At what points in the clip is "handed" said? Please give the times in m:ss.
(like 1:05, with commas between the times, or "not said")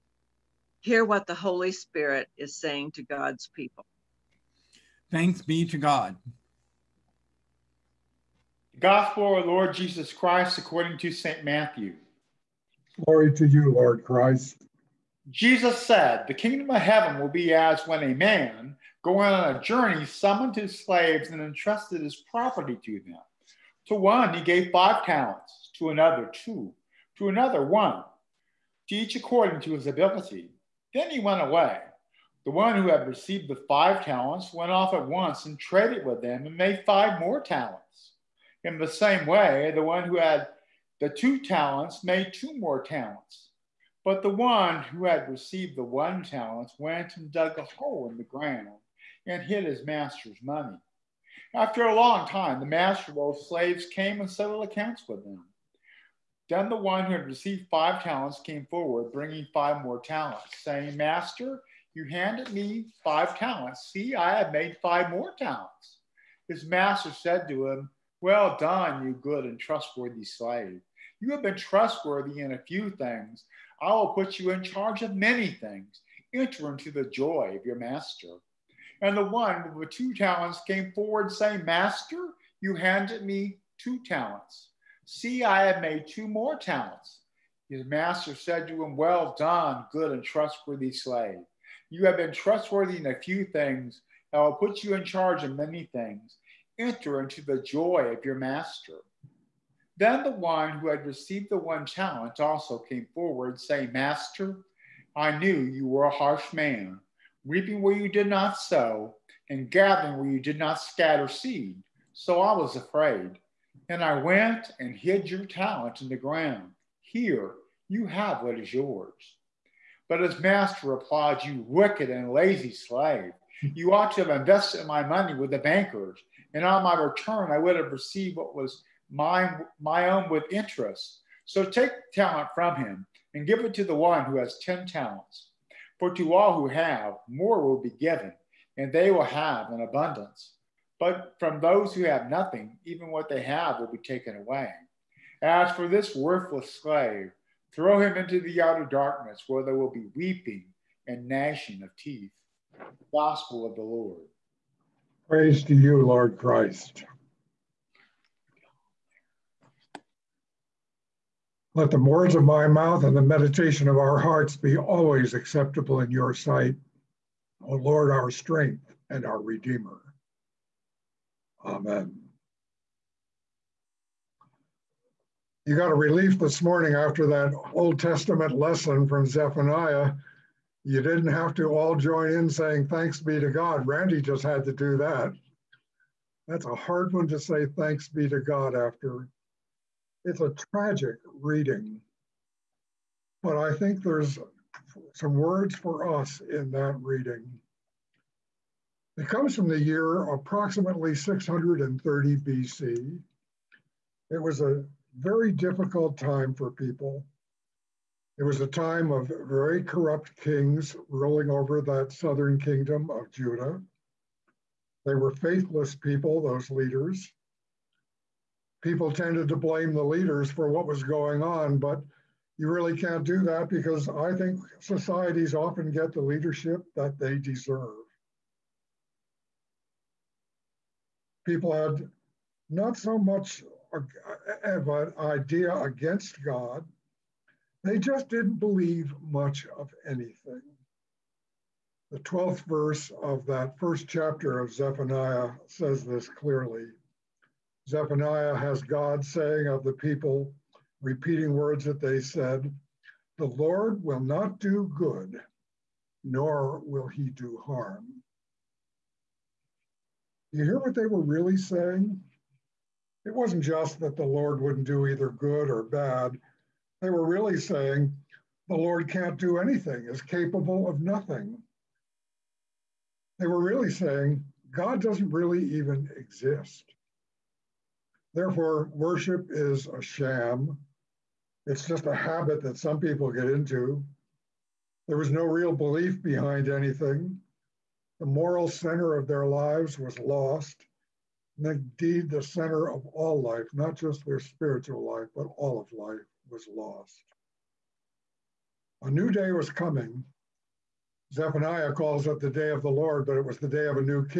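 1:02, 1:22.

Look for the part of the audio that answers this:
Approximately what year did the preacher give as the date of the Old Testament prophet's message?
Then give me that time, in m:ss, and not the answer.
3:21.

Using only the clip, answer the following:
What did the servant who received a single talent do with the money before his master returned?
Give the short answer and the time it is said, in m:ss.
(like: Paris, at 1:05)
dug a hole in the ground, at 0:47.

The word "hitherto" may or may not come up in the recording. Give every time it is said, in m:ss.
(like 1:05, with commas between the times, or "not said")
not said.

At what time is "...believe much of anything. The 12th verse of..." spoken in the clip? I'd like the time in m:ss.
3:58.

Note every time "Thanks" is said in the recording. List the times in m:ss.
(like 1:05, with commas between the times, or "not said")
0:05, 3:02, 3:07.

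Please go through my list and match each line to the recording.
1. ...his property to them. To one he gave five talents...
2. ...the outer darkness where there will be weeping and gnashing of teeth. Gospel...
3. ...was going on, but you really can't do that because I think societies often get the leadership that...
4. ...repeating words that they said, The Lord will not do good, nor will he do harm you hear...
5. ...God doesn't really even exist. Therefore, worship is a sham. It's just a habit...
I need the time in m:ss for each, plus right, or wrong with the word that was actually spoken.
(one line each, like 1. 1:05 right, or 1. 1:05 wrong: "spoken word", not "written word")
1. 0:22 right
2. 2:28 right
3. 3:40 right
4. 4:11 right
5. 4:34 right.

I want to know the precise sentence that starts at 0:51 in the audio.
After a long time, the master of those slaves came and settled accounts with them.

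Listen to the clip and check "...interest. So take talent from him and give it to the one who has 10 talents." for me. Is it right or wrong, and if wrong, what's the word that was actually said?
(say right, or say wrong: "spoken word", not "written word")
right.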